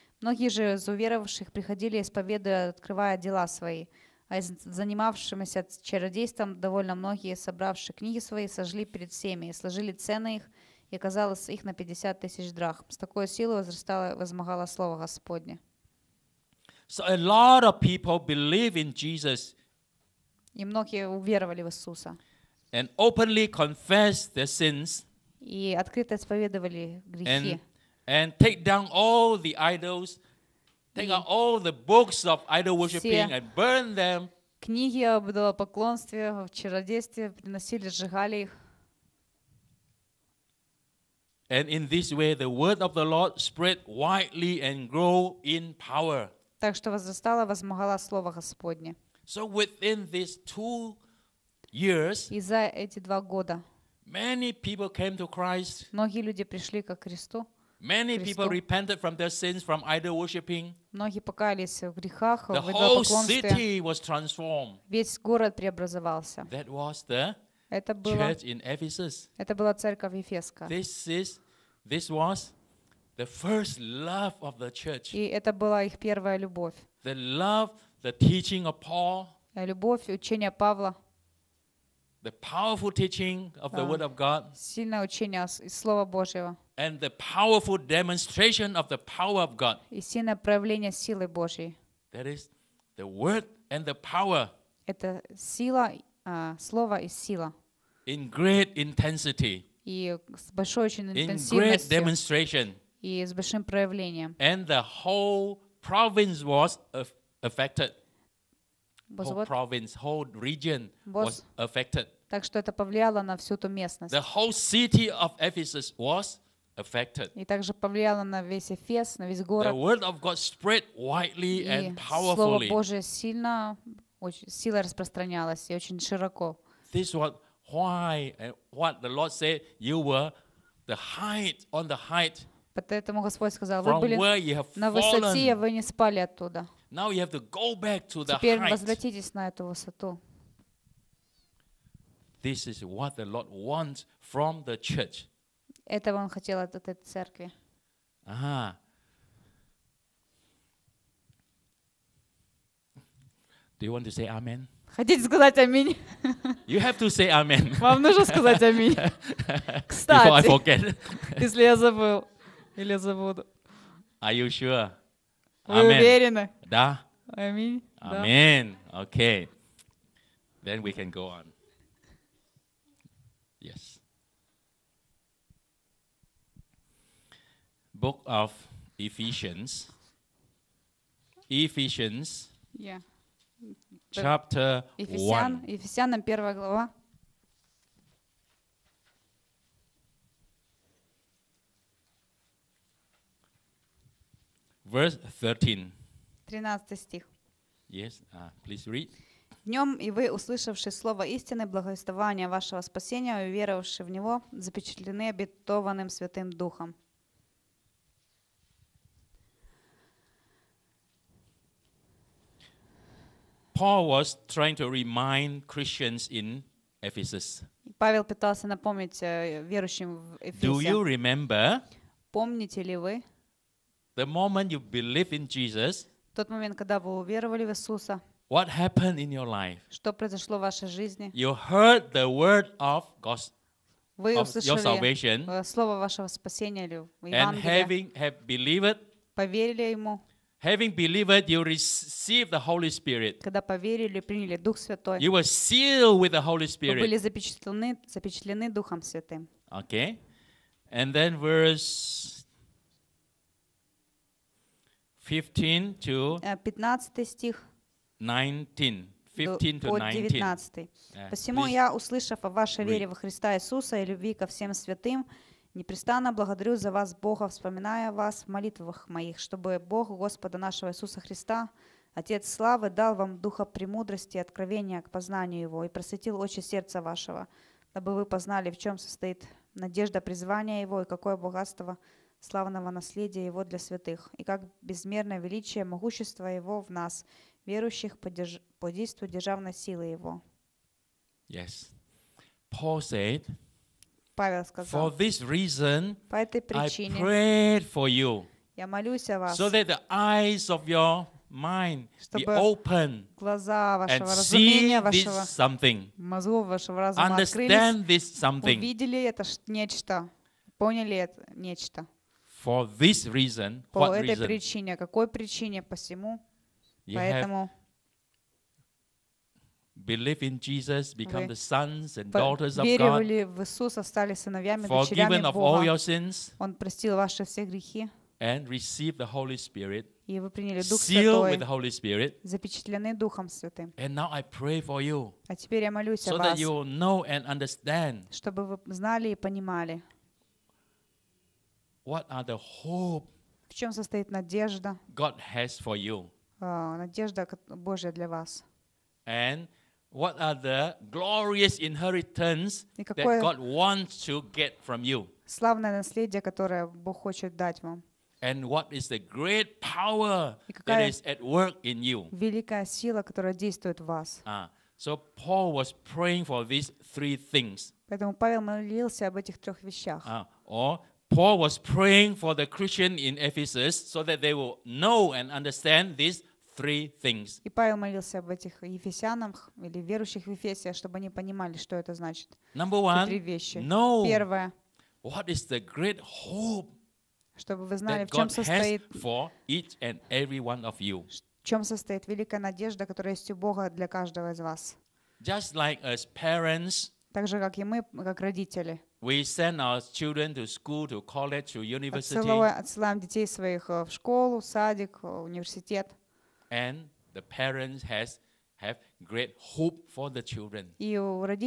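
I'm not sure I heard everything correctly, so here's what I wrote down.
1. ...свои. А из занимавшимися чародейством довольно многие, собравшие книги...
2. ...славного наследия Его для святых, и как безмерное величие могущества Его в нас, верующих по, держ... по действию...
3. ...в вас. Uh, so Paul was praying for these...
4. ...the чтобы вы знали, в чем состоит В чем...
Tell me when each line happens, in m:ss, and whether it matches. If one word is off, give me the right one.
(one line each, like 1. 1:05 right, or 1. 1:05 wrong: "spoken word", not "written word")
1. 0:03 right
2. 4:42 right
3. 6:04 right
4. 6:25 right.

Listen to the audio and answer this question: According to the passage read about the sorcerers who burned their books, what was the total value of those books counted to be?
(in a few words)
50,000 drachmas.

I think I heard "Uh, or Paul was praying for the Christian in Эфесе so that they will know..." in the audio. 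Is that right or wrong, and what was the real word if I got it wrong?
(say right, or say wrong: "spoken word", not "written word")
wrong: "Ephesus", not "Эфесе".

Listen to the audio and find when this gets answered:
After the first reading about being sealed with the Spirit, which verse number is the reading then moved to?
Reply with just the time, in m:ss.
4:17.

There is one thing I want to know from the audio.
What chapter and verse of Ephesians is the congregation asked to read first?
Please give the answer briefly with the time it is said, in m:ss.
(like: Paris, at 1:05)
Chapter 1, verse 13, at 3:05.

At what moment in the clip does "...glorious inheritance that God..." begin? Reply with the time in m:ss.
5:51.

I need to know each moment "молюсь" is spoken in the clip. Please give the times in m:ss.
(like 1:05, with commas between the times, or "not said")
4:58, 5:35.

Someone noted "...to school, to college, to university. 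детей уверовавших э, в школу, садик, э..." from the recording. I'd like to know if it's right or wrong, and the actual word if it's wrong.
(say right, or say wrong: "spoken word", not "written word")
wrong: "своих", not "уверовавших".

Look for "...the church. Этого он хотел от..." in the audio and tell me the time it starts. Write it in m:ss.
2:24.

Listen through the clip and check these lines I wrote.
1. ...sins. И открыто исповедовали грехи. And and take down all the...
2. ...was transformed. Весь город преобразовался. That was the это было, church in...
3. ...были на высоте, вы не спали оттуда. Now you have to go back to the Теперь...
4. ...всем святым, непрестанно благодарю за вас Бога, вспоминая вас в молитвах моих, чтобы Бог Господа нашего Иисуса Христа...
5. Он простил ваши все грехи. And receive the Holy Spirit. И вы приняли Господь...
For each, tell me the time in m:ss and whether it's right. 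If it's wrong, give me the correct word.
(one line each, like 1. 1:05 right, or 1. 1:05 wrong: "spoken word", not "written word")
1. 0:24 right
2. 1:03 right
3. 2:13 right
4. 4:24 right
5. 5:26 wrong: "Дух", not "Господь".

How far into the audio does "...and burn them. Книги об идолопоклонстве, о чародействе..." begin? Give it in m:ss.
0:33.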